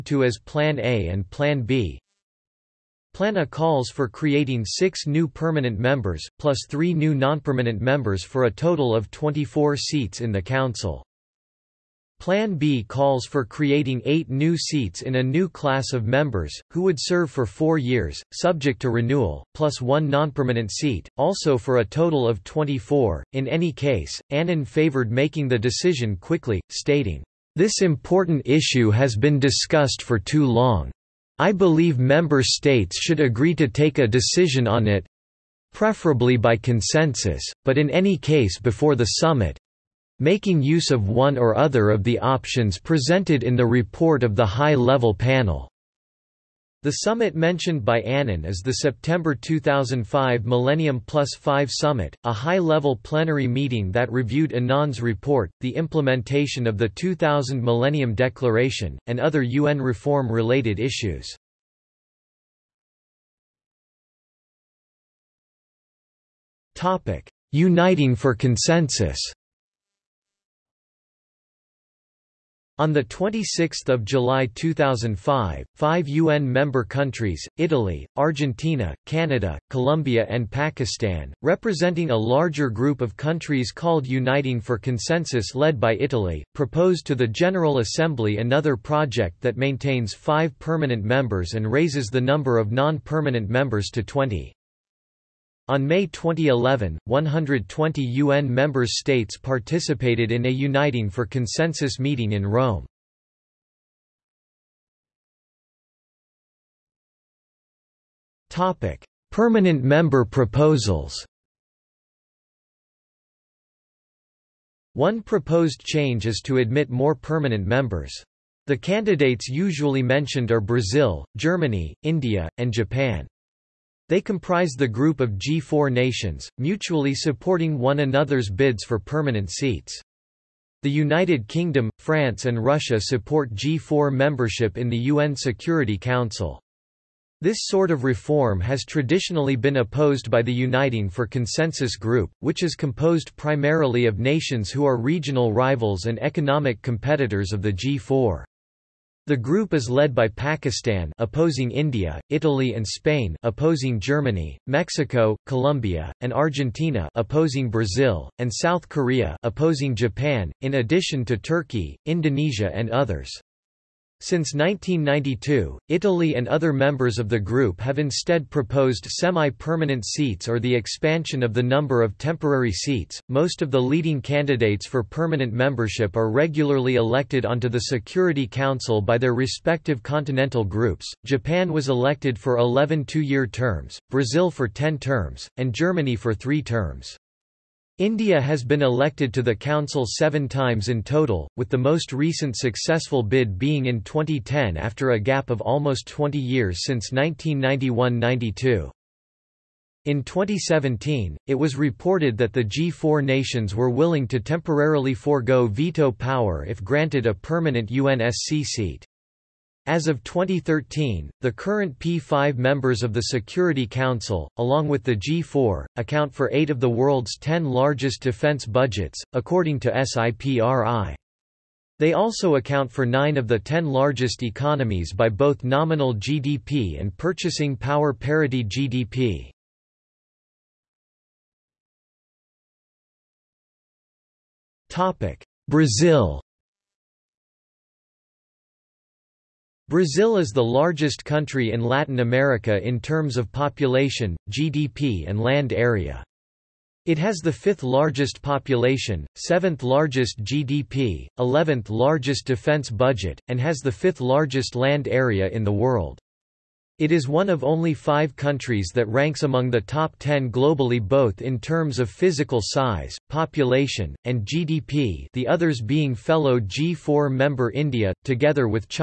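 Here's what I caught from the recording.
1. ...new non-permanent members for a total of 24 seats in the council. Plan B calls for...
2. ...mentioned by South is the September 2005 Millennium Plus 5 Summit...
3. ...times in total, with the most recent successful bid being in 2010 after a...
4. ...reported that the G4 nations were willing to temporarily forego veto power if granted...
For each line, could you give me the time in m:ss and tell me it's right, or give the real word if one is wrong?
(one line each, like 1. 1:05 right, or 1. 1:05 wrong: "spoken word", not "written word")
1. 0:06 right
2. 0:47 wrong: "Annan", not "South"
3. 3:10 right
4. 3:21 right.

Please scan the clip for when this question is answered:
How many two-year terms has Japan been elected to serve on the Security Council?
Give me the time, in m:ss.
3:02.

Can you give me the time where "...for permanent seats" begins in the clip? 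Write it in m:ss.
2:08.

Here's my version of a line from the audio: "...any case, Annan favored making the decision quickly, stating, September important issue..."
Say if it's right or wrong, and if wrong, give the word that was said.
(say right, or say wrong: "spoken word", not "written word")
wrong: "This", not "September".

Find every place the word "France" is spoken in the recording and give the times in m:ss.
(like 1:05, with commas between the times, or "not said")
2:11.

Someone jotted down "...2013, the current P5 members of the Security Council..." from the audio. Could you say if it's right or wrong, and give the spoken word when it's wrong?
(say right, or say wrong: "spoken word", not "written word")
right.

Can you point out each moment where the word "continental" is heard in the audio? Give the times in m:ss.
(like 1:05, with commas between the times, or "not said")
3:00.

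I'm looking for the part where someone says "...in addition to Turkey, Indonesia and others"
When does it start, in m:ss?
2:40.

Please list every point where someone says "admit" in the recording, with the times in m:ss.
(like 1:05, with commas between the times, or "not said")
1:56.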